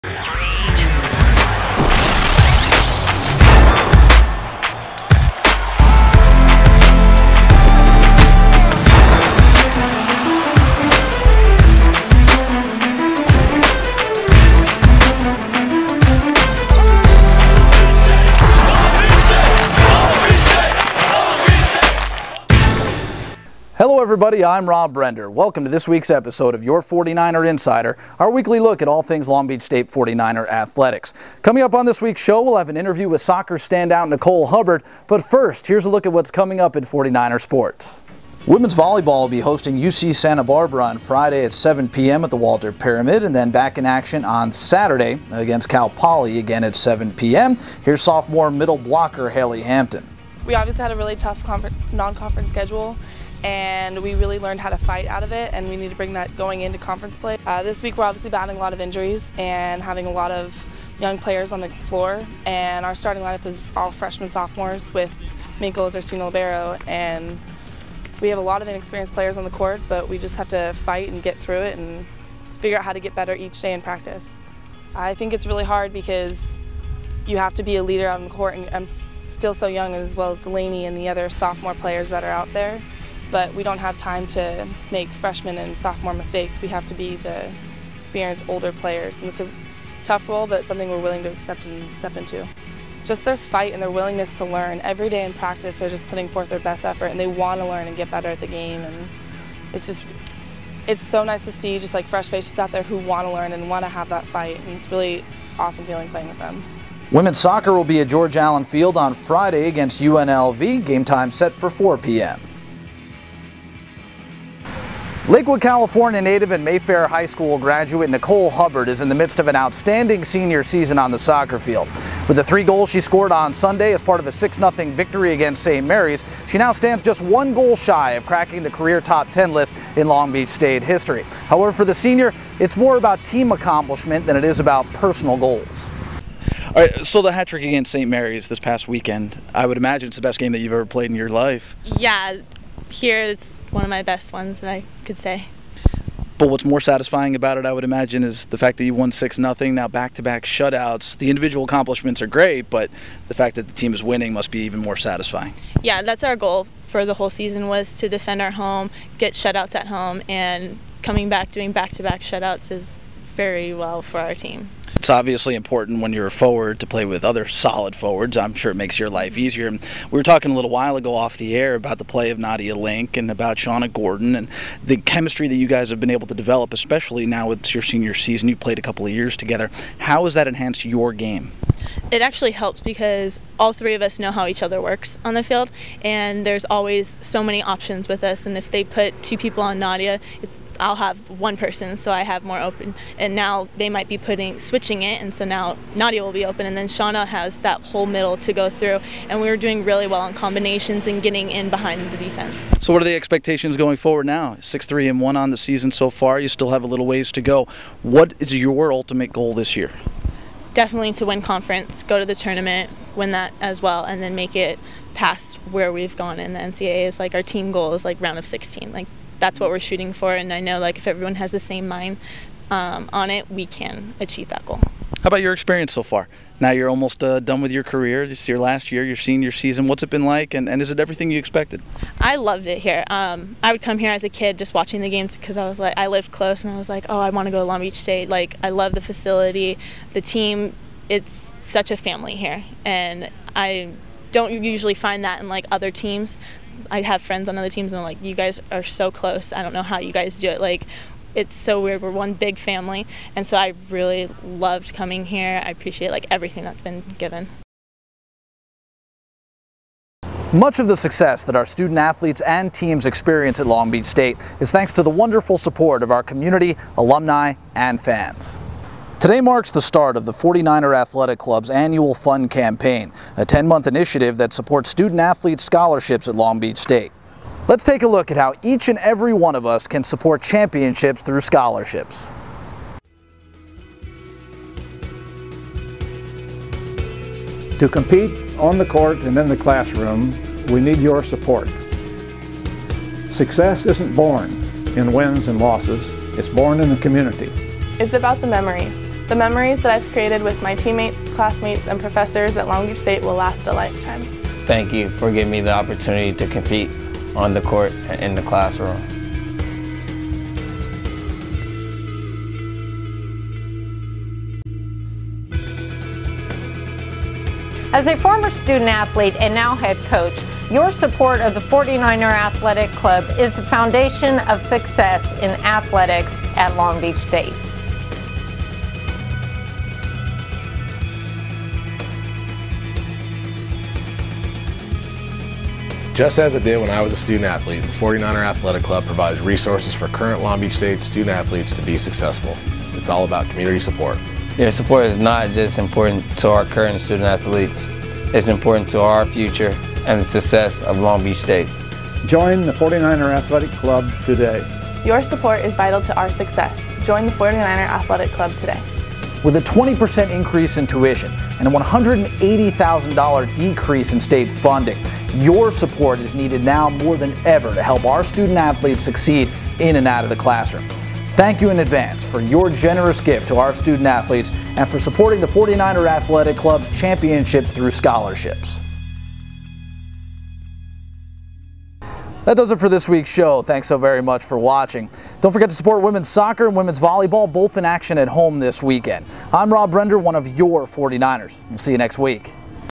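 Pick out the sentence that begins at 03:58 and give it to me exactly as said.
Like, I love the facility, the team.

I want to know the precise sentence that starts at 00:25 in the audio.
Welcome to this week's episode of Your 49er Insider, our weekly look at all things Long Beach State 49er athletics.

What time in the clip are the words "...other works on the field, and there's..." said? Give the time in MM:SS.
03:04.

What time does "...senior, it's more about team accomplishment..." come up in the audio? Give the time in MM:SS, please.
02:11.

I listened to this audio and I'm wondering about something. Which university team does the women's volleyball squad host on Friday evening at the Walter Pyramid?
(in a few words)
UC Santa Barbara.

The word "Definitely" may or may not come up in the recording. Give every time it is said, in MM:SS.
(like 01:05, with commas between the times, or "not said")
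03:30.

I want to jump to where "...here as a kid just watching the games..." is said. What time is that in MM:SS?
03:53.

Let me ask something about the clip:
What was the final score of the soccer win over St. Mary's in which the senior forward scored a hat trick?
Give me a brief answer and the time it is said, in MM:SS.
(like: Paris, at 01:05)
6-0, at 02:04.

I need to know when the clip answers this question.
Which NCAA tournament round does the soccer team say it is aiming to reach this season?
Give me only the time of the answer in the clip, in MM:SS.
03:38.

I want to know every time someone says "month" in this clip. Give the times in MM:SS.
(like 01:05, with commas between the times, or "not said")
04:33.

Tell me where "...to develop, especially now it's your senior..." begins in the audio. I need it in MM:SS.
02:56.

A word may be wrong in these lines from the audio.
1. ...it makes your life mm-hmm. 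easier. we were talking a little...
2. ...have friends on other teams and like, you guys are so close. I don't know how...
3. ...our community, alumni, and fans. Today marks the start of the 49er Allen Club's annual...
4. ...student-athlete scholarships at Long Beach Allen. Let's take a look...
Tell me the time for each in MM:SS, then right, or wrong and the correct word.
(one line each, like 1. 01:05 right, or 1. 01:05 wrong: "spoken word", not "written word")
1. 02:48 right
2. 04:07 right
3. 04:26 wrong: "Athletic", not "Allen"
4. 04:34 wrong: "State", not "Allen".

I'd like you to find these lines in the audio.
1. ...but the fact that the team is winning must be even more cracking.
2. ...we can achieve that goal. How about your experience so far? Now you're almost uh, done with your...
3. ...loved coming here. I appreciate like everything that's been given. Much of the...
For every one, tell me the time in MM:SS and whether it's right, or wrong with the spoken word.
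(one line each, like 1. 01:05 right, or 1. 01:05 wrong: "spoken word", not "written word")
1. 02:32 wrong: "satisfying", not "cracking"
2. 03:43 right
3. 04:14 right.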